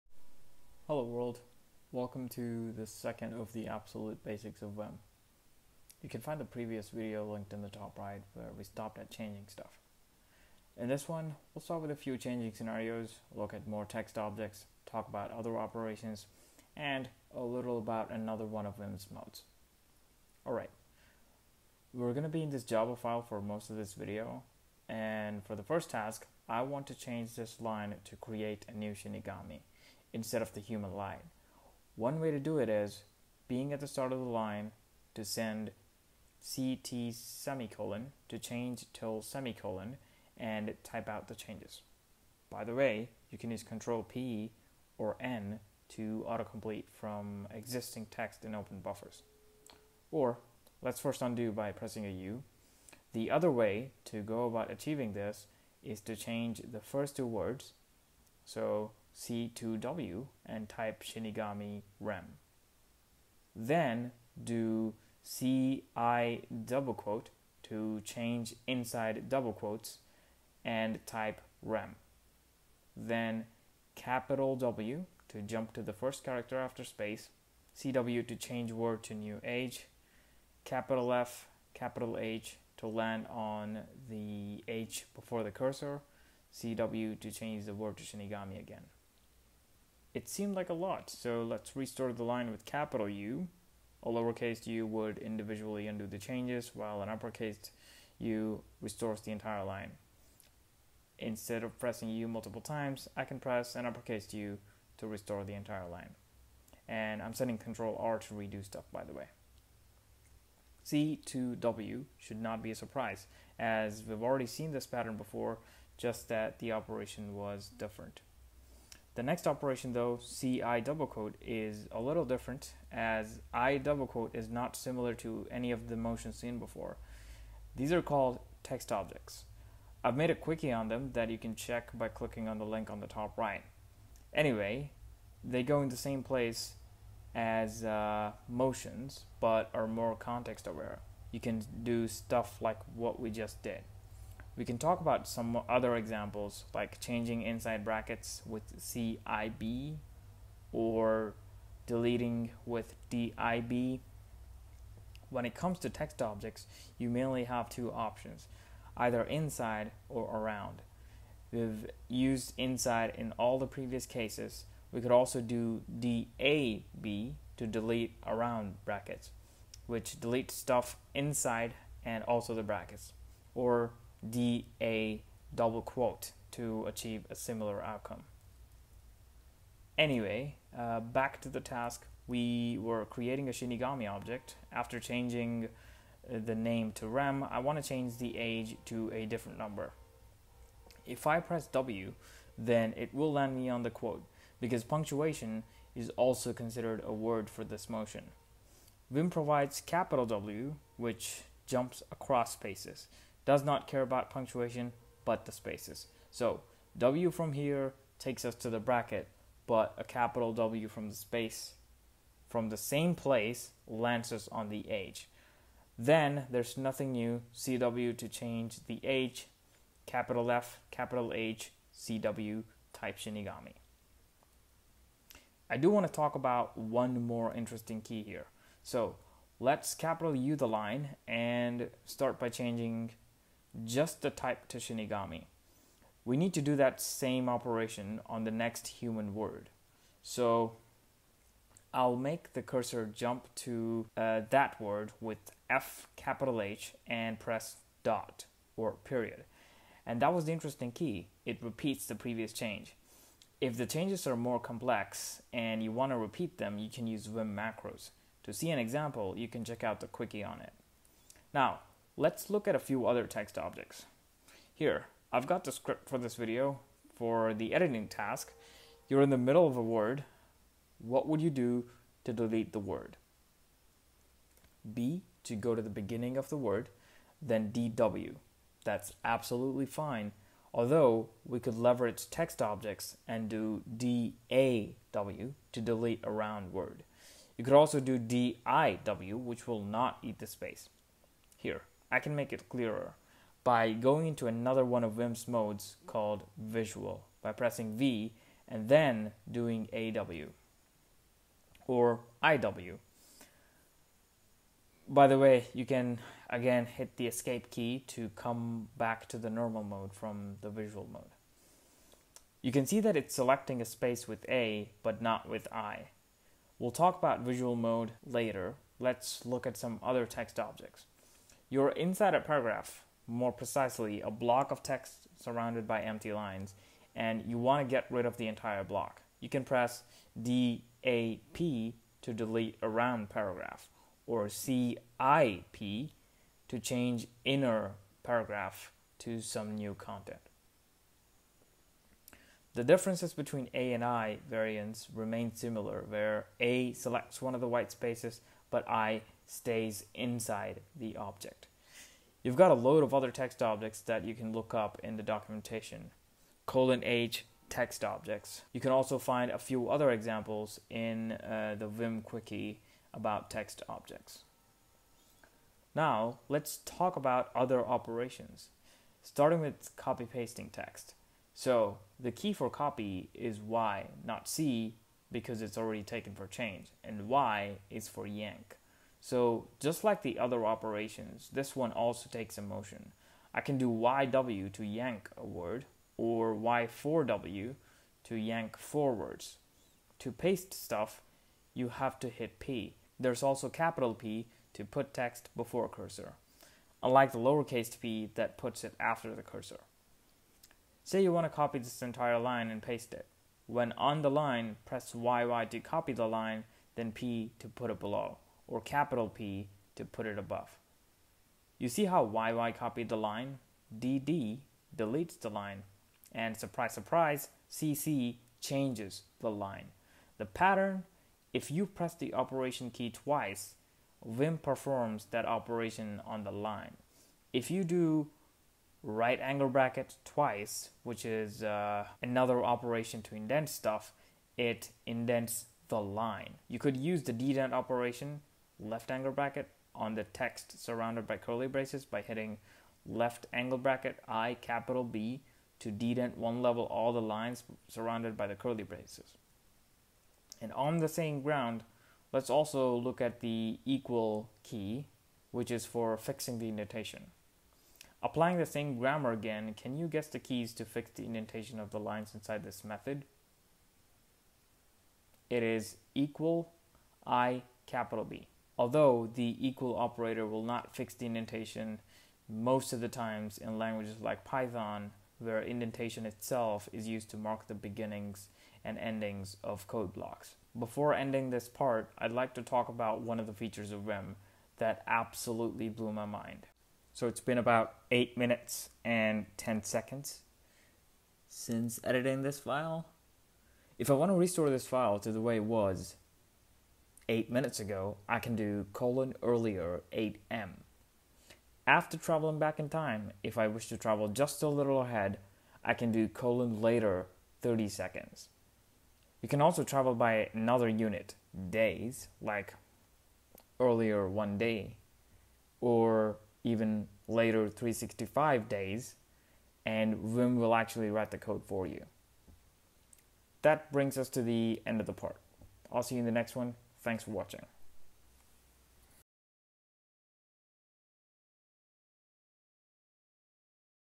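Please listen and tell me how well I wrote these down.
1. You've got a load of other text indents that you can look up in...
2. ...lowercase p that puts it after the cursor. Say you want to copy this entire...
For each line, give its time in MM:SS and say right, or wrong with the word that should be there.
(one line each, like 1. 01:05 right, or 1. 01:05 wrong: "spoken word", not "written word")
1. 05:52 wrong: "objects", not "indents"
2. 06:37 right.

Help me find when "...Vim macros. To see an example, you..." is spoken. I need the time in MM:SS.
04:17.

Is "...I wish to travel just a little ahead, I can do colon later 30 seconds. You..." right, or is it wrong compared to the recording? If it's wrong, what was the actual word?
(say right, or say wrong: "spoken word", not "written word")
right.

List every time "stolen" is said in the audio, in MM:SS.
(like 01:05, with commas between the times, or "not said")
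not said.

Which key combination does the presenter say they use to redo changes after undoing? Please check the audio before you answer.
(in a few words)
Control R.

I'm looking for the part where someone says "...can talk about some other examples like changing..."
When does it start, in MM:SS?
02:24.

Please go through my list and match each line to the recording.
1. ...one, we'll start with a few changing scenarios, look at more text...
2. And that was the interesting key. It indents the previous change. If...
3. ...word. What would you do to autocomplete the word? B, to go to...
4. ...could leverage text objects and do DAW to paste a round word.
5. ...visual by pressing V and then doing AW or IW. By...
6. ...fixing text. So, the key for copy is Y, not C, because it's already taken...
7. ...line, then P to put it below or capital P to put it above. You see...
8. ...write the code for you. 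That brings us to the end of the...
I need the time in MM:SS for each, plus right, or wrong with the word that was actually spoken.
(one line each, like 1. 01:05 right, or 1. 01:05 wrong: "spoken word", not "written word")
1. 00:11 right
2. 04:10 wrong: "repeats", not "indents"
3. 04:29 wrong: "delete", not "autocomplete"
4. 04:41 wrong: "delete", not "paste"
5. 04:56 right
6. 06:10 wrong: "pasting", not "fixing"
7. 06:46 right
8. 08:41 right.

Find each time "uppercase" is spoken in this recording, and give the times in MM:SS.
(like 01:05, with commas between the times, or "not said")
01:37, 01:43.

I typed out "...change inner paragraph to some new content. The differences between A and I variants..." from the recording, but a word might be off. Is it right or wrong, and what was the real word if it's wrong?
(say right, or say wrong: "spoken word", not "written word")
right.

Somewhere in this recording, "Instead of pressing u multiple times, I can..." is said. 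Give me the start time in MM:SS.
01:41.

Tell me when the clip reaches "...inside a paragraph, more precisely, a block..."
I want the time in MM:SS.
05:21.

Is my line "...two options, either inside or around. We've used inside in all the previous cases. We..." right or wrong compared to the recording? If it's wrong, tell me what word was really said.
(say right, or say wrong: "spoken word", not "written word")
right.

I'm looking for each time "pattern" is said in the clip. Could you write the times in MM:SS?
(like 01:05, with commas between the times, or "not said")
01:54, 07:00.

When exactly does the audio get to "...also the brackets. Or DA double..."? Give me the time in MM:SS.
02:52.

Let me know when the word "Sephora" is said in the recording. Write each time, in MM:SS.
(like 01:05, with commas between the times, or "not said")
not said.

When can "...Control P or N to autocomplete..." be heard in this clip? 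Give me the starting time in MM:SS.
00:43.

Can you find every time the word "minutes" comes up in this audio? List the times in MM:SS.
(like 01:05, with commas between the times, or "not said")
08:08, 08:17.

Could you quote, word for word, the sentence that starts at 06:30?
To paste stuff, you have to hit P.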